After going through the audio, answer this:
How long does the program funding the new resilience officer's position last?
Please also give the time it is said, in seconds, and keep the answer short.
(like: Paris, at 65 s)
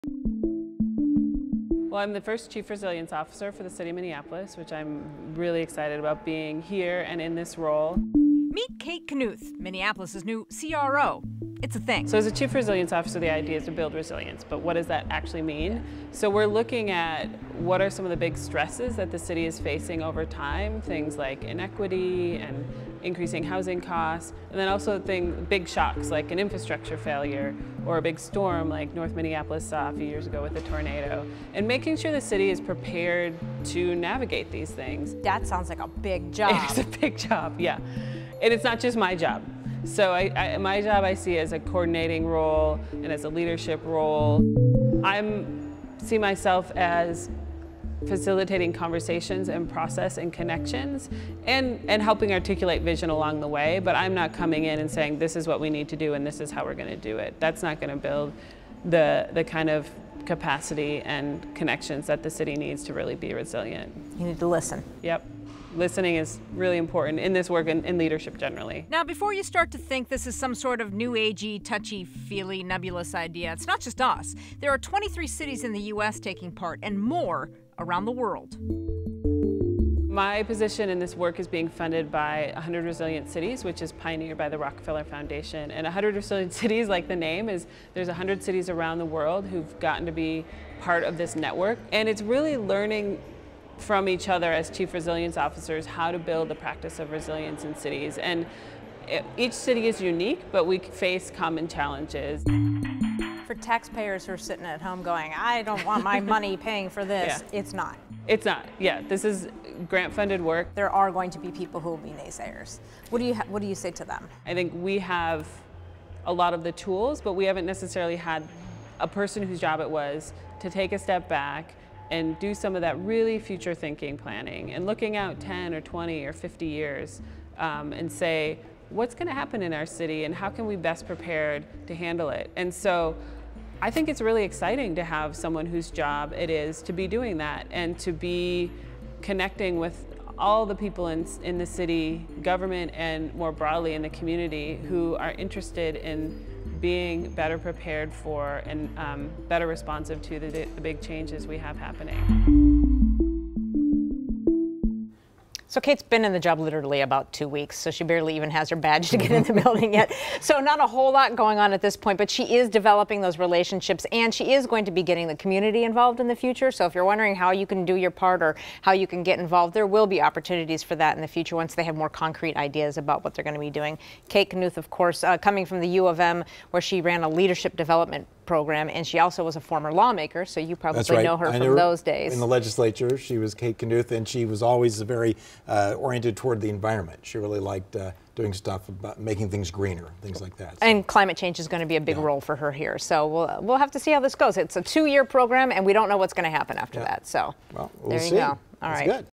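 2 years, at 194 s.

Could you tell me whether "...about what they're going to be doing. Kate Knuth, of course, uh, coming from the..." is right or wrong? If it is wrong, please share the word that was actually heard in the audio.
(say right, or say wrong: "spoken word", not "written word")
right.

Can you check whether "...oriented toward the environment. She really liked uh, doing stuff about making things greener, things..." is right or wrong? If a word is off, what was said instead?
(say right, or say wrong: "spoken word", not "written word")
right.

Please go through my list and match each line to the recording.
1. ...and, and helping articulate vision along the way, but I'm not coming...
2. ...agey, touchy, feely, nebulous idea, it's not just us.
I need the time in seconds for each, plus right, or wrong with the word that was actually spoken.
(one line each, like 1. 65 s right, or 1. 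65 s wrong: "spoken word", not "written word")
1. 51 s right
2. 71 s right.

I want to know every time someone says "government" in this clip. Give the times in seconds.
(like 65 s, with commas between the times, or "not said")
142 s.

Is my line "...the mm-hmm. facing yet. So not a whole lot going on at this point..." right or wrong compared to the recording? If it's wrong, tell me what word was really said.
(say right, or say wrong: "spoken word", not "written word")
wrong: "building", not "facing".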